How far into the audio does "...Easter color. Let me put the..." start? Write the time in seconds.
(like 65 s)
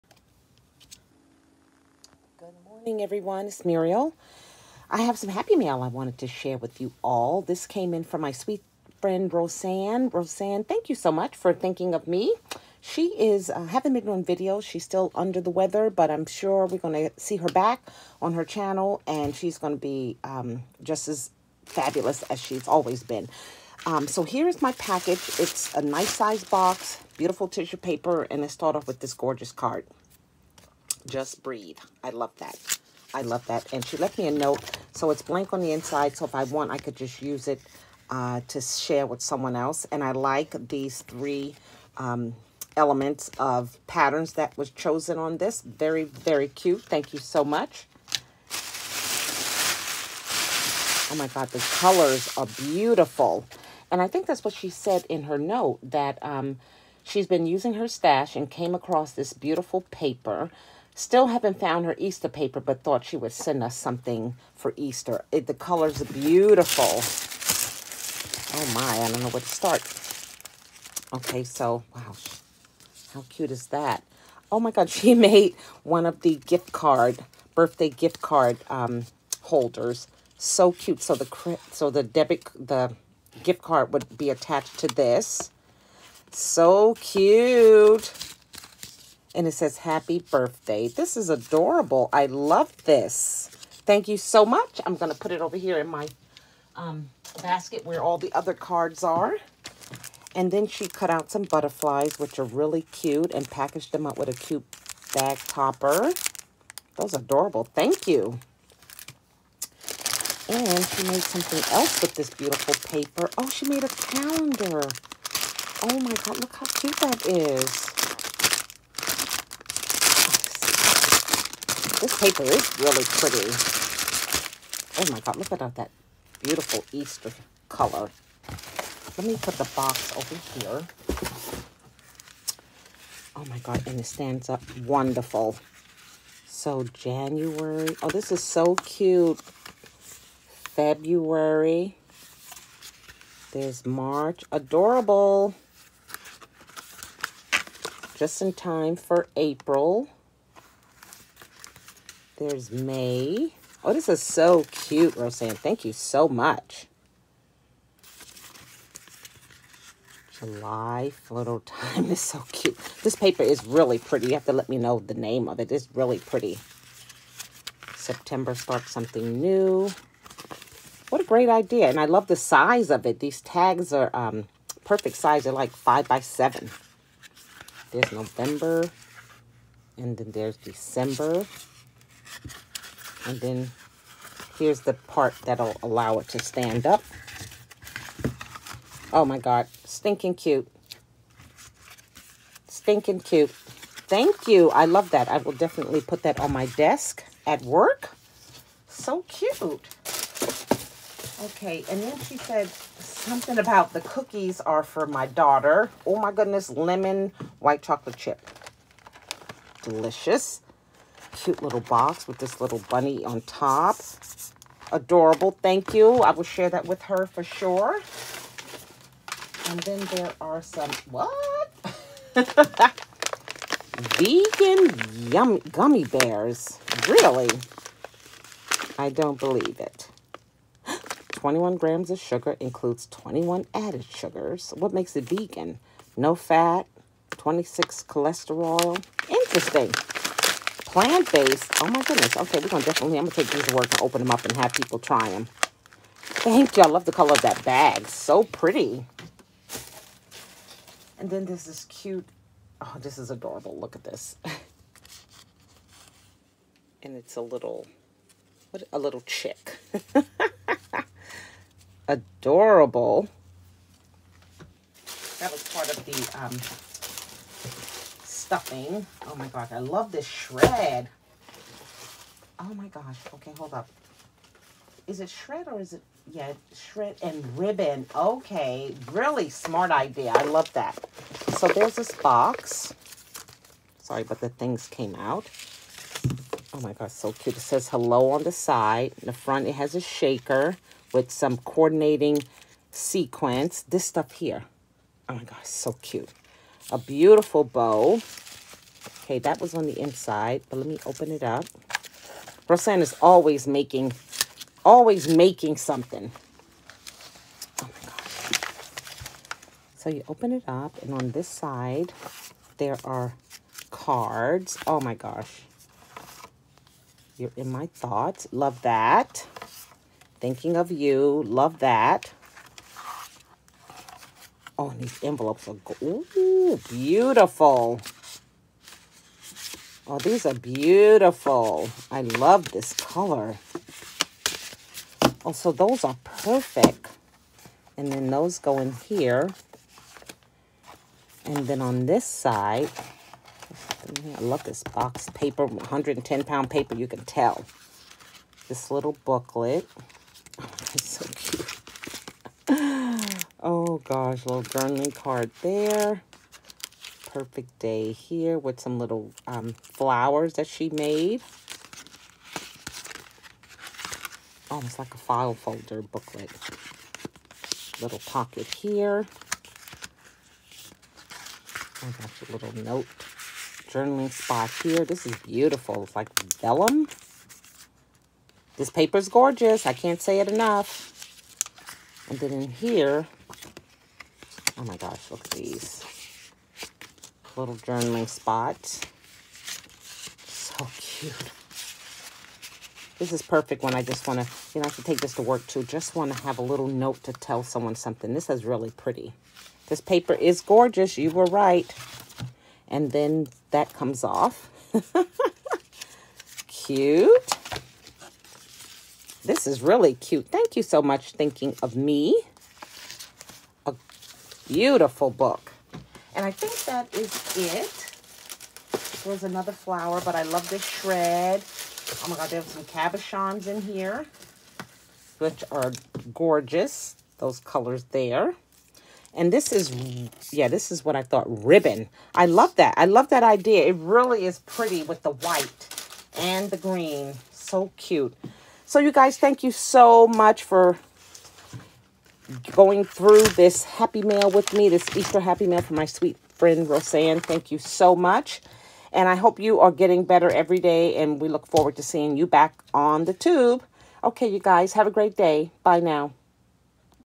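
126 s.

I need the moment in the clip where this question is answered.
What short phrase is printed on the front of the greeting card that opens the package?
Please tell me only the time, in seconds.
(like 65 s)
31 s.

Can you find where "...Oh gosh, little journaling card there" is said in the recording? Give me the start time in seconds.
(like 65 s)
353 s.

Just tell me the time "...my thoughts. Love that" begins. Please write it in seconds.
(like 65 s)
317 s.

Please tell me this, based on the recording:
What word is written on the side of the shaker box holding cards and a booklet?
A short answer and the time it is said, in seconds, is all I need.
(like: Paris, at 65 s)
Hello, at 287 s.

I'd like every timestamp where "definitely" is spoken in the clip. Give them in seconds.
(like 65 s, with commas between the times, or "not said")
195 s, 242 s.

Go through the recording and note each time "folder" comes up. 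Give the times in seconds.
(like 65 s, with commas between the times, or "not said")
365 s.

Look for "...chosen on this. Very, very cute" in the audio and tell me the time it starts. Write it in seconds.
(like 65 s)
44 s.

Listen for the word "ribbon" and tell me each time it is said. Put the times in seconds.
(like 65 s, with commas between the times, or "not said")
277 s, 431 s.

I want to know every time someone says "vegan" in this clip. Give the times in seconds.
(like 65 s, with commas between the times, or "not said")
224 s, 235 s.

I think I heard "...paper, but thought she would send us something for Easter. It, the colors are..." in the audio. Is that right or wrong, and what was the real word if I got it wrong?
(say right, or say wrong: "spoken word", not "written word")
right.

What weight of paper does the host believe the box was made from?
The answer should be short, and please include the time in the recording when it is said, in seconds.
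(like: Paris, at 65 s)
110 pound, at 345 s.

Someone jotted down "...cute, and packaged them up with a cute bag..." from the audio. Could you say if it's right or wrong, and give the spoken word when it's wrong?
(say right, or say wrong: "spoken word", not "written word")
right.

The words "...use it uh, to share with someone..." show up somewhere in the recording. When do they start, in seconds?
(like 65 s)
37 s.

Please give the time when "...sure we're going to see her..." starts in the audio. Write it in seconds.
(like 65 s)
16 s.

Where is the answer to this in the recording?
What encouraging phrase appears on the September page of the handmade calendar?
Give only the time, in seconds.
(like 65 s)
168 s.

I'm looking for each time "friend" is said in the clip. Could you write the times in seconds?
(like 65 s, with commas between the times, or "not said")
8 s, 446 s.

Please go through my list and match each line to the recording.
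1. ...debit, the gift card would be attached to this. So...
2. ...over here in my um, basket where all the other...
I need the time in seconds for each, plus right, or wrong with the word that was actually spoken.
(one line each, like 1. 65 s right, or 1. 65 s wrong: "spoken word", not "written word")
1. 82 s right
2. 95 s right.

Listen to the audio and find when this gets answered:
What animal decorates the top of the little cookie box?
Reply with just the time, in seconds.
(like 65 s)
212 s.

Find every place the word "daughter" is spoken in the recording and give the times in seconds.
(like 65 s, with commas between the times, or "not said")
205 s.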